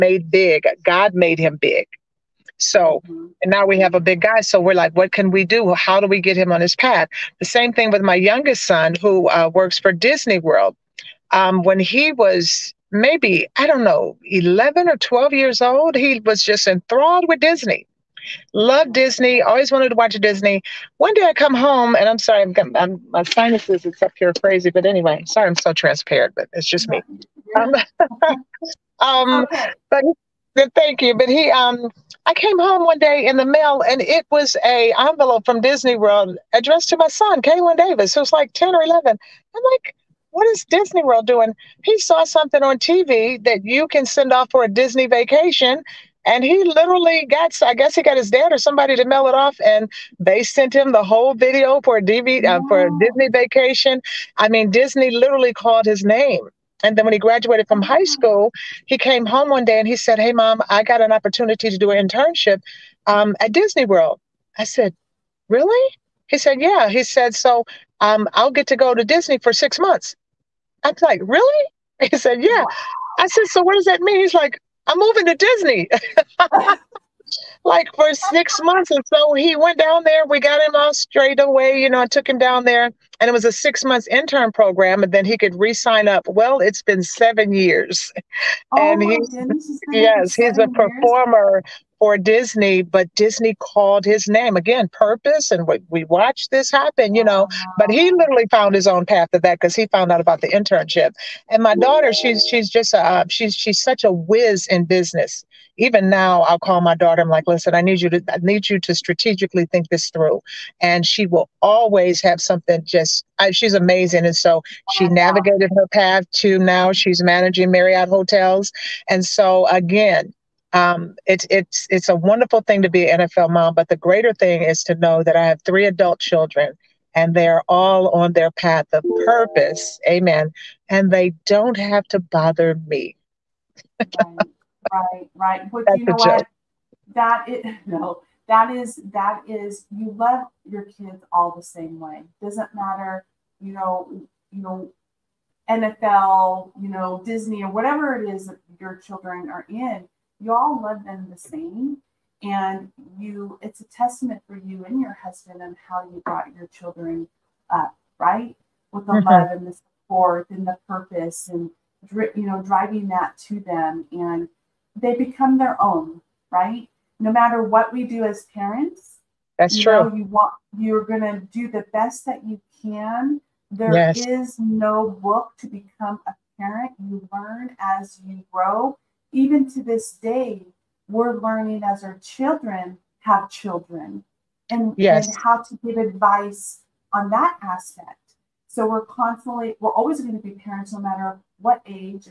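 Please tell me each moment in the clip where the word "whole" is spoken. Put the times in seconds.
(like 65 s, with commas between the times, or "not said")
51 s.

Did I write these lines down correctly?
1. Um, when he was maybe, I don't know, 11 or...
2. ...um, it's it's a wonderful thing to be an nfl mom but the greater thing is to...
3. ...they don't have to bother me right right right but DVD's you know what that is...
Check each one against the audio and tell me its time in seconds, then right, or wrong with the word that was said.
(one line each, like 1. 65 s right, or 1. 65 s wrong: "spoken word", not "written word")
1. 11 s right
2. 120 s right
3. 131 s wrong: "That", not "DVD".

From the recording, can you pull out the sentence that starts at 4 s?
So we're like, what can we do?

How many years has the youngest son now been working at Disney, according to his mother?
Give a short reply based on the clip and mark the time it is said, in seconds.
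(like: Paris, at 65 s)
7, at 87 s.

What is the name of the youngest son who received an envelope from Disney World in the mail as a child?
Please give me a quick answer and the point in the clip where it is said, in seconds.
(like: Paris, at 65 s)
Kaylin Davis, at 37 s.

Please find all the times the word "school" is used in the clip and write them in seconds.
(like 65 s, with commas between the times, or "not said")
58 s.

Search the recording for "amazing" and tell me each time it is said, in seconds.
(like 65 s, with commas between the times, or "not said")
113 s.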